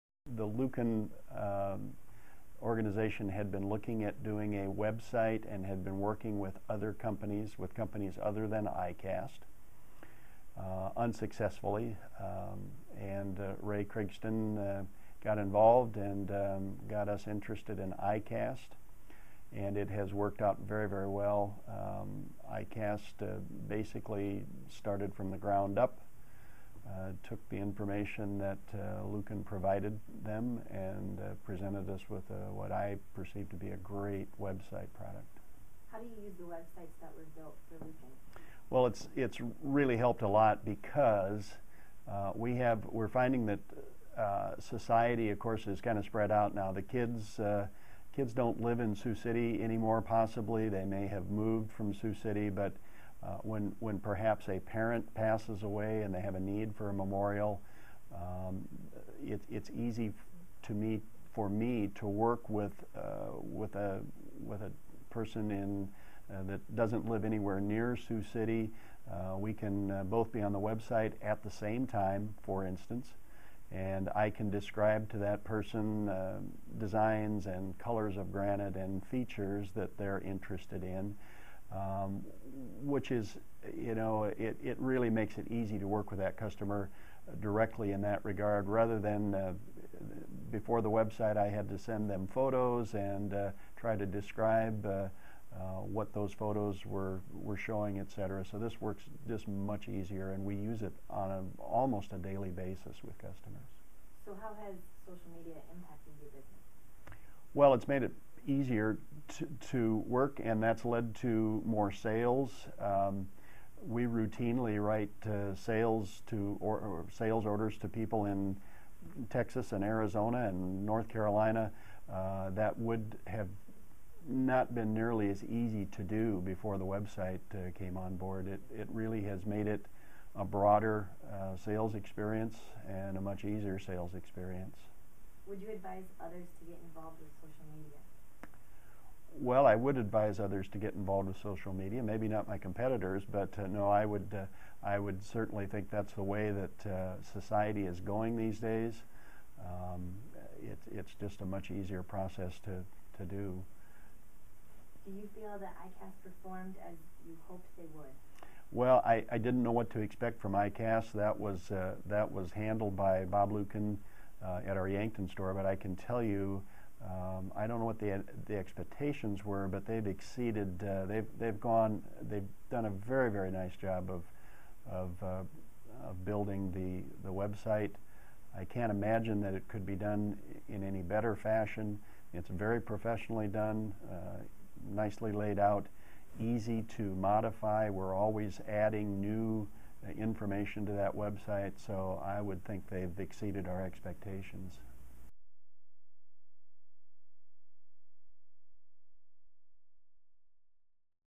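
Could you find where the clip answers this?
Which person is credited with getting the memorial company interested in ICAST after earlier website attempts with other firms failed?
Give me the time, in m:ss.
0:13.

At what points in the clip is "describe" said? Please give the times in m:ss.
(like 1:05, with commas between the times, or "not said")
1:14, 1:34.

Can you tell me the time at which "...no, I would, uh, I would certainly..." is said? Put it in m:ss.
2:23.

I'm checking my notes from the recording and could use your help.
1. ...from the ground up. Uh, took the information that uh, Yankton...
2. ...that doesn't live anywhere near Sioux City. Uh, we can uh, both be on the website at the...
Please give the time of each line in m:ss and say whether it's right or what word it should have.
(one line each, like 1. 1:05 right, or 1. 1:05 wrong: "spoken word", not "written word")
1. 0:25 wrong: "Luken", not "Yankton"
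2. 1:06 right.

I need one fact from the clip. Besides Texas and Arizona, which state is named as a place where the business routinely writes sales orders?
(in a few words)
North Carolina.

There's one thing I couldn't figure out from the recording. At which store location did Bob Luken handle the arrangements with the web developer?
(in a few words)
Yankton.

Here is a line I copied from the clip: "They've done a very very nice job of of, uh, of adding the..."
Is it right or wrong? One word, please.
wrong.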